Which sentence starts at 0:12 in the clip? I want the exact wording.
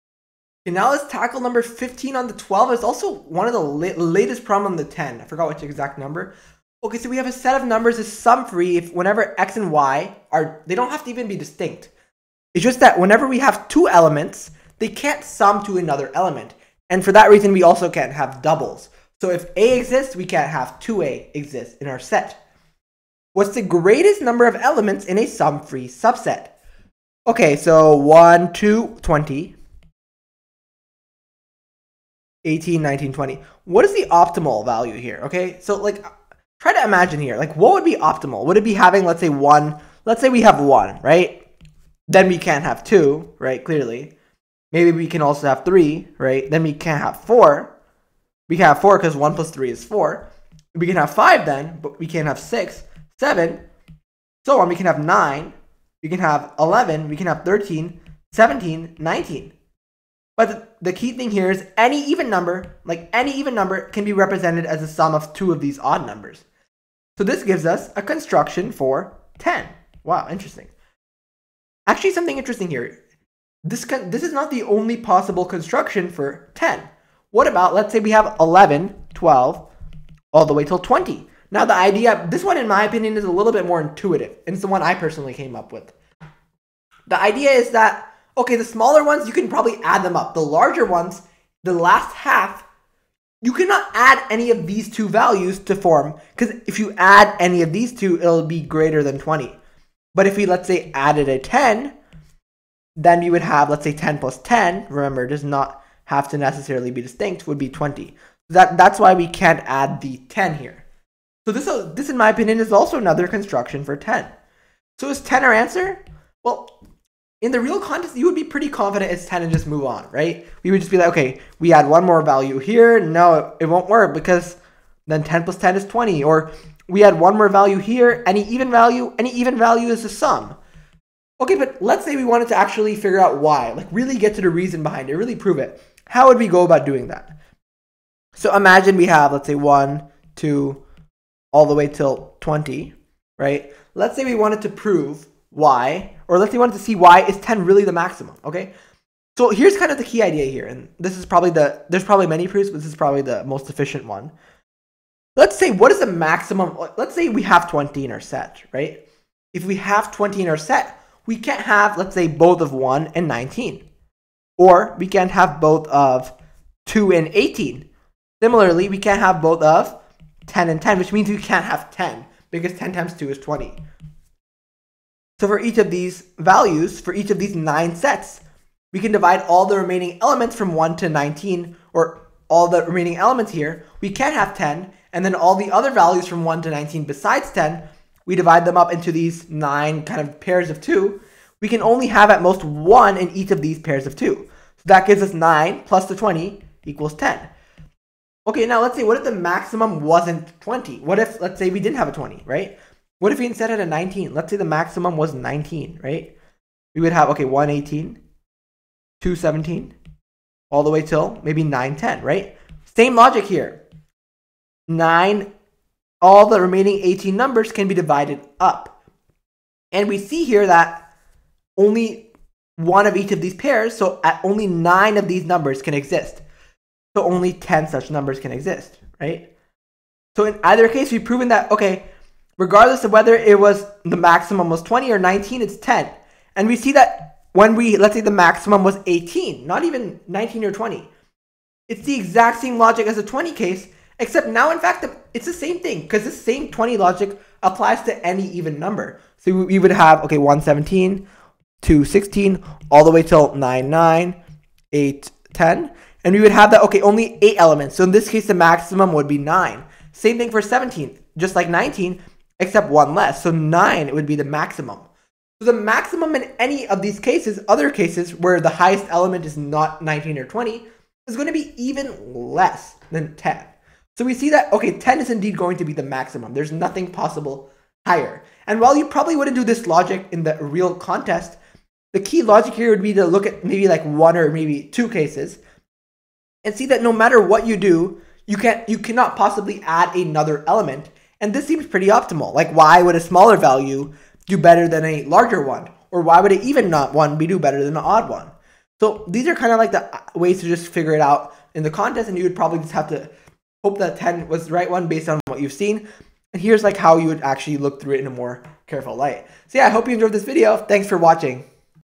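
It's just that whenever we have two elements, they can't sum to another element.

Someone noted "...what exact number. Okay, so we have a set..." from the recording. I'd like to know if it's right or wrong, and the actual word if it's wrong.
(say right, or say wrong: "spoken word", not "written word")
right.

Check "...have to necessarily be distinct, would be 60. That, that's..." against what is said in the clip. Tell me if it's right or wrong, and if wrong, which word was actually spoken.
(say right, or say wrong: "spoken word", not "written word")
wrong: "20", not "60".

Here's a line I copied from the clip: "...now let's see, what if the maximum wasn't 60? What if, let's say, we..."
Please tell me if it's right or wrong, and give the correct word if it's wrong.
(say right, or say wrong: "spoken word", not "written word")
wrong: "20", not "60".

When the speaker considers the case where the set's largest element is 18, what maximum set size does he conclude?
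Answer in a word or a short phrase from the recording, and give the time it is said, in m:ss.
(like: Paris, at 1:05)
9, at 4:18.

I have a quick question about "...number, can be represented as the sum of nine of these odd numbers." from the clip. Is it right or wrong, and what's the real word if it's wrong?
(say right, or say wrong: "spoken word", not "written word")
wrong: "two", not "nine".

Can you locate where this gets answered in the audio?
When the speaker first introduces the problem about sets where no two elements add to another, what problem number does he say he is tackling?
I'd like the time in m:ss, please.
0:01.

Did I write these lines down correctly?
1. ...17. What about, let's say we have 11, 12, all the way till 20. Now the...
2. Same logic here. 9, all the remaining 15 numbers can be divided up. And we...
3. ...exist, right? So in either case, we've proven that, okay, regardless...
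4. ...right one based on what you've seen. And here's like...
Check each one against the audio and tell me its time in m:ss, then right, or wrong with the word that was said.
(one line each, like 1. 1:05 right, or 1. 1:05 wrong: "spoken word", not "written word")
1. 1:16 wrong: "10", not "17"
2. 3:32 wrong: "18", not "15"
3. 3:48 right
4. 5:04 right.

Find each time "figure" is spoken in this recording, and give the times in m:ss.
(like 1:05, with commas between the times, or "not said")
2:12, 5:00.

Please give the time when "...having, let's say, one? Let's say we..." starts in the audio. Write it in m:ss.
0:38.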